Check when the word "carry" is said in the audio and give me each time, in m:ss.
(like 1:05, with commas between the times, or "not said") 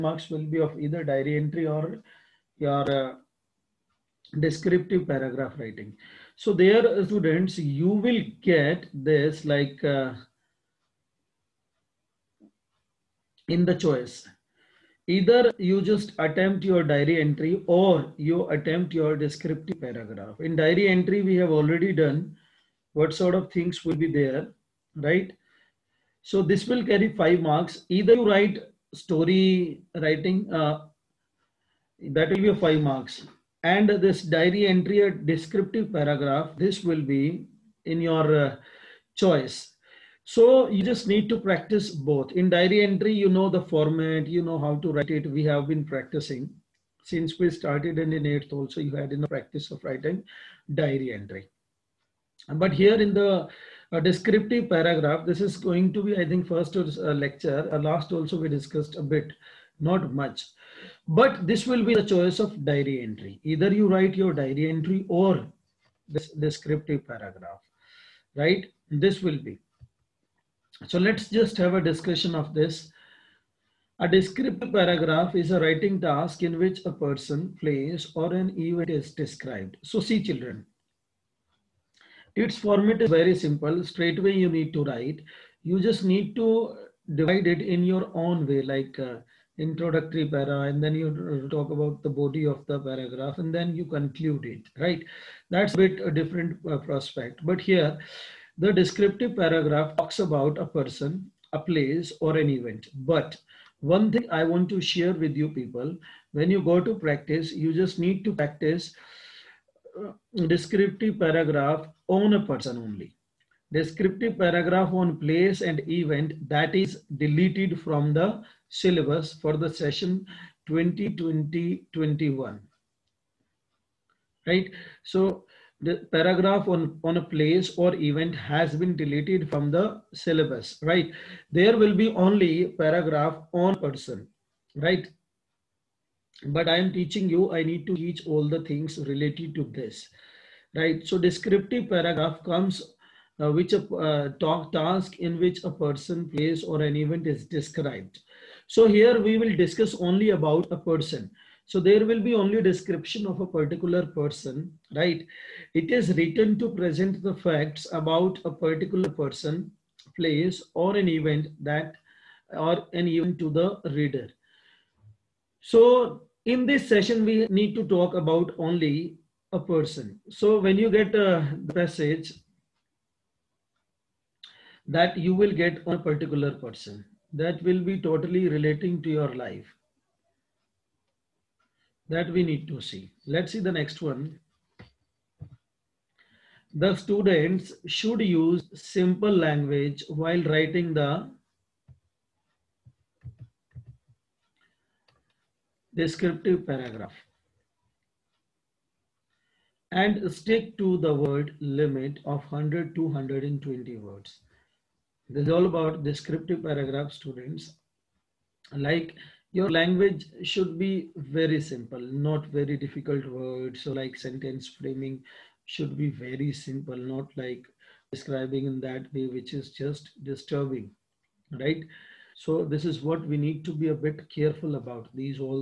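0:26.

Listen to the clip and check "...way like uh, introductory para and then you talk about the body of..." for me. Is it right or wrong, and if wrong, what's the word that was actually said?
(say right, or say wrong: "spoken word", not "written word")
right.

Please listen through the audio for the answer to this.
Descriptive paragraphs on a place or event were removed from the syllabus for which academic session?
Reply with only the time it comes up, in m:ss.
2:00.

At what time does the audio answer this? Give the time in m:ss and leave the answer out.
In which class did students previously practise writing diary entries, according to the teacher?
0:48.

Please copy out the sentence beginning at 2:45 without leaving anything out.
So in this session, we need to talk about only a person.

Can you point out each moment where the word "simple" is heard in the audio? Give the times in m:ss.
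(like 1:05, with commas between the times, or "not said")
1:23, 3:08, 3:31, 3:36.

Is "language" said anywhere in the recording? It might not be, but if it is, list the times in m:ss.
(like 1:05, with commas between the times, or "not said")
3:09, 3:29.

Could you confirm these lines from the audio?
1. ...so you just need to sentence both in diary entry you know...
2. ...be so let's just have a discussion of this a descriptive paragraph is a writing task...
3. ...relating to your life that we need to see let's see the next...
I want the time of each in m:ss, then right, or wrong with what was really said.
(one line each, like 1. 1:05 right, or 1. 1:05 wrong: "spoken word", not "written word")
1. 0:40 wrong: "practice", not "sentence"
2. 1:09 right
3. 2:58 right.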